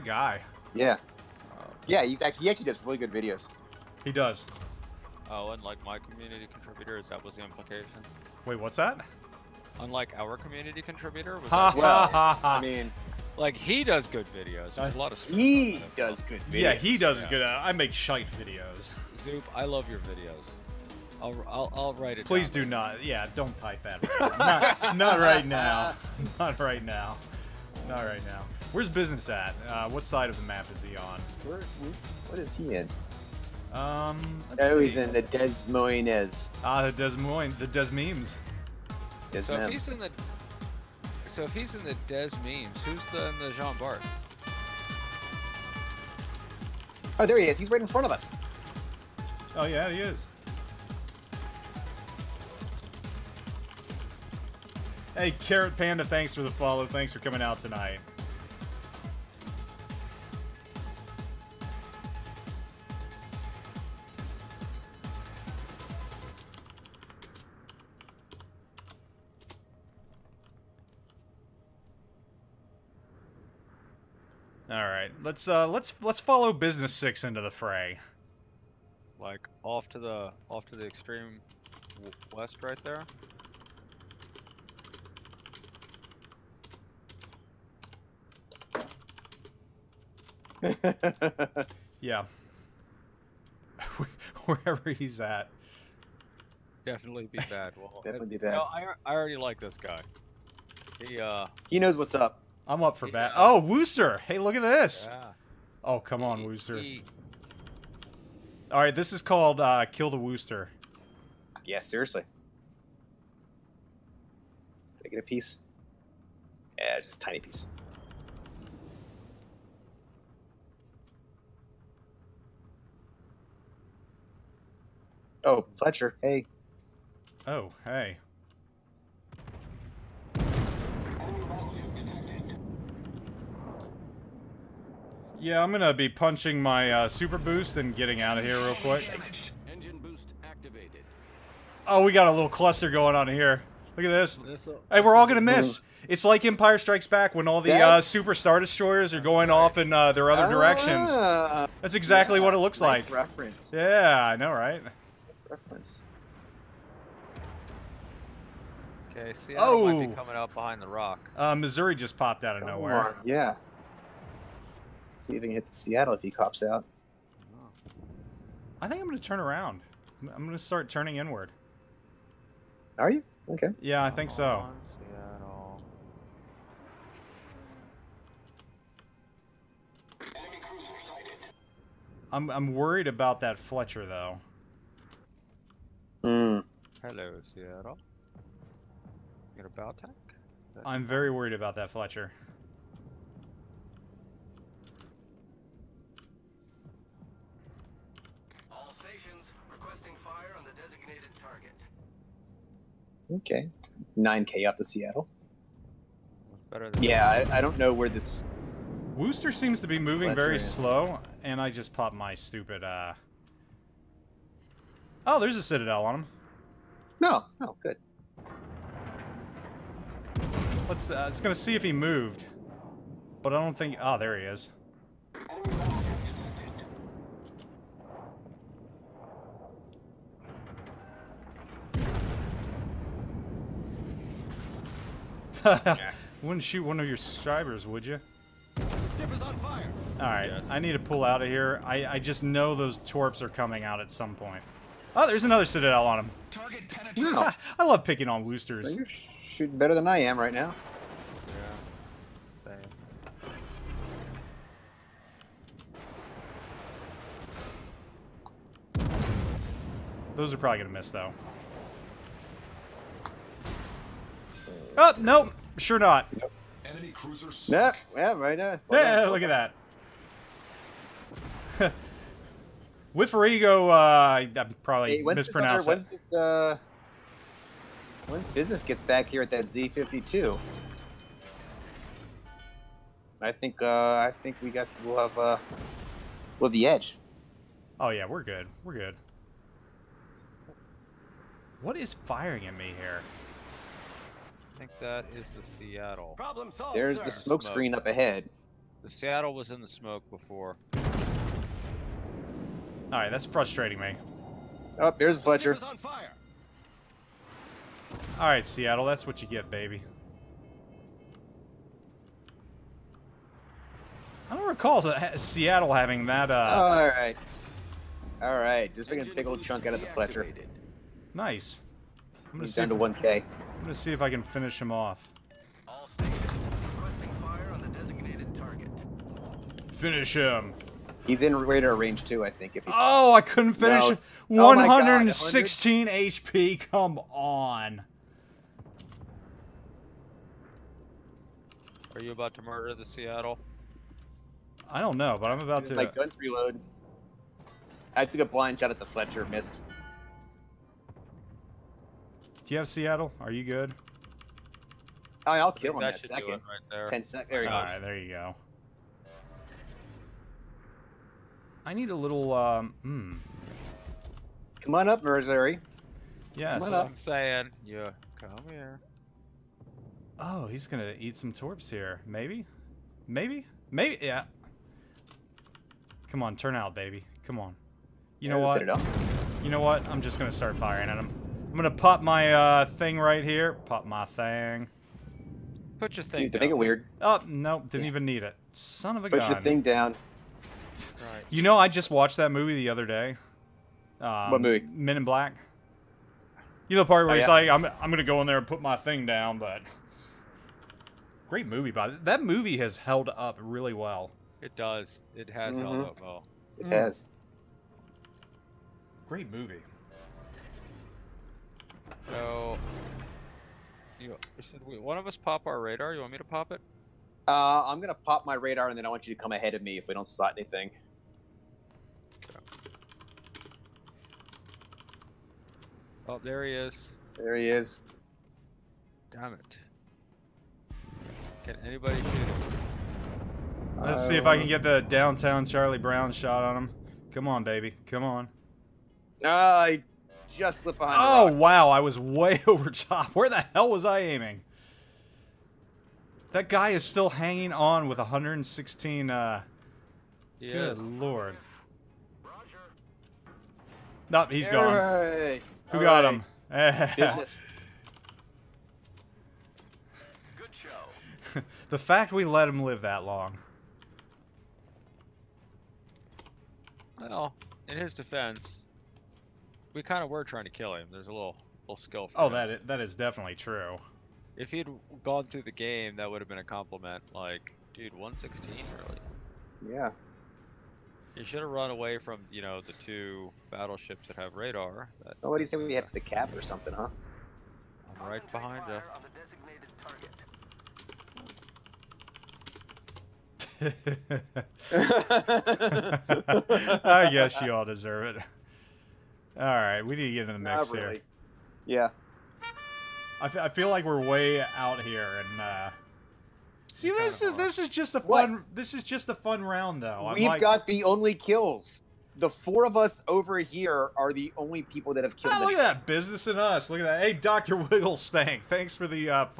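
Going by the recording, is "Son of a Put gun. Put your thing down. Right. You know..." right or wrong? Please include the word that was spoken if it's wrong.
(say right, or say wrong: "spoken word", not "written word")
right.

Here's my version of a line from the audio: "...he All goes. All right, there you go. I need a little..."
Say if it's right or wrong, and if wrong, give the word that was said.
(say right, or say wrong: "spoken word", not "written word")
right.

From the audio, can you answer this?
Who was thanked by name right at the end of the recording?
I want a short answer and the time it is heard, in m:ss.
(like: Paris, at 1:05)
Doctor Wigglespank, at 8:37.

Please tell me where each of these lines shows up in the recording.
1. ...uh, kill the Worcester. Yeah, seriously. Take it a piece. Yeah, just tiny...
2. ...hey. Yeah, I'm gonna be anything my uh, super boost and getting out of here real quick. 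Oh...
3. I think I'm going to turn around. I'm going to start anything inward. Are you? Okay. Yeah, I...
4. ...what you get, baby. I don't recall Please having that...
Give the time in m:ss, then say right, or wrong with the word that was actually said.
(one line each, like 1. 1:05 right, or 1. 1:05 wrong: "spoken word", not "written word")
1. 1:49 right
2. 2:07 wrong: "punching", not "anything"
3. 2:48 wrong: "turning", not "anything"
4. 5:09 wrong: "Seattle", not "Please".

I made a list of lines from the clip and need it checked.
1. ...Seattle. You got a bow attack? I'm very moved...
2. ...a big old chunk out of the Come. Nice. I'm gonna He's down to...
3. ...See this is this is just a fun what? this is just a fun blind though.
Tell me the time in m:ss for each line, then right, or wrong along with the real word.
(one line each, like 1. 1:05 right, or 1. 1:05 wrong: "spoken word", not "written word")
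1. 3:07 wrong: "worried", not "moved"
2. 5:19 wrong: "Fletcher", not "Come"
3. 8:26 wrong: "round", not "blind".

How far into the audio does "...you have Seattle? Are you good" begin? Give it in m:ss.
5:52.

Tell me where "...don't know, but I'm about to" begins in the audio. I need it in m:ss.
5:45.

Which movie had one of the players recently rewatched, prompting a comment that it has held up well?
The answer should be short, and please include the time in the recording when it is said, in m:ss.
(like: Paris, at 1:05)
Men in Black, at 6:34.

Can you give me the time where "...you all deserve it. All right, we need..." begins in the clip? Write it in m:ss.
8:17.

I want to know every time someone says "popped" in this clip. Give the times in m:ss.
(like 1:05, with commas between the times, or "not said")
2:42, 3:31.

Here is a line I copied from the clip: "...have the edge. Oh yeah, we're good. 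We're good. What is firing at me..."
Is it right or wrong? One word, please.
right.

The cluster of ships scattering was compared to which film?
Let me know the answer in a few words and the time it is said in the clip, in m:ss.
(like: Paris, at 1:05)
Empire Strikes Back, at 2:26.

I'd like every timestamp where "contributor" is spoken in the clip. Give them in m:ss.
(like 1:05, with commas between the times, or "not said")
0:06, 0:10.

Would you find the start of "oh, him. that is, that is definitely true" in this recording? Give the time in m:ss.
7:52.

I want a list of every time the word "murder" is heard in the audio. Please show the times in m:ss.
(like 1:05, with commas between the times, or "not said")
5:42.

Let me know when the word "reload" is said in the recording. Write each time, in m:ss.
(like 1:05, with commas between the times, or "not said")
5:46.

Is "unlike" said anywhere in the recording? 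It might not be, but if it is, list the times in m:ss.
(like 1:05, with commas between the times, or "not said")
0:05, 0:09.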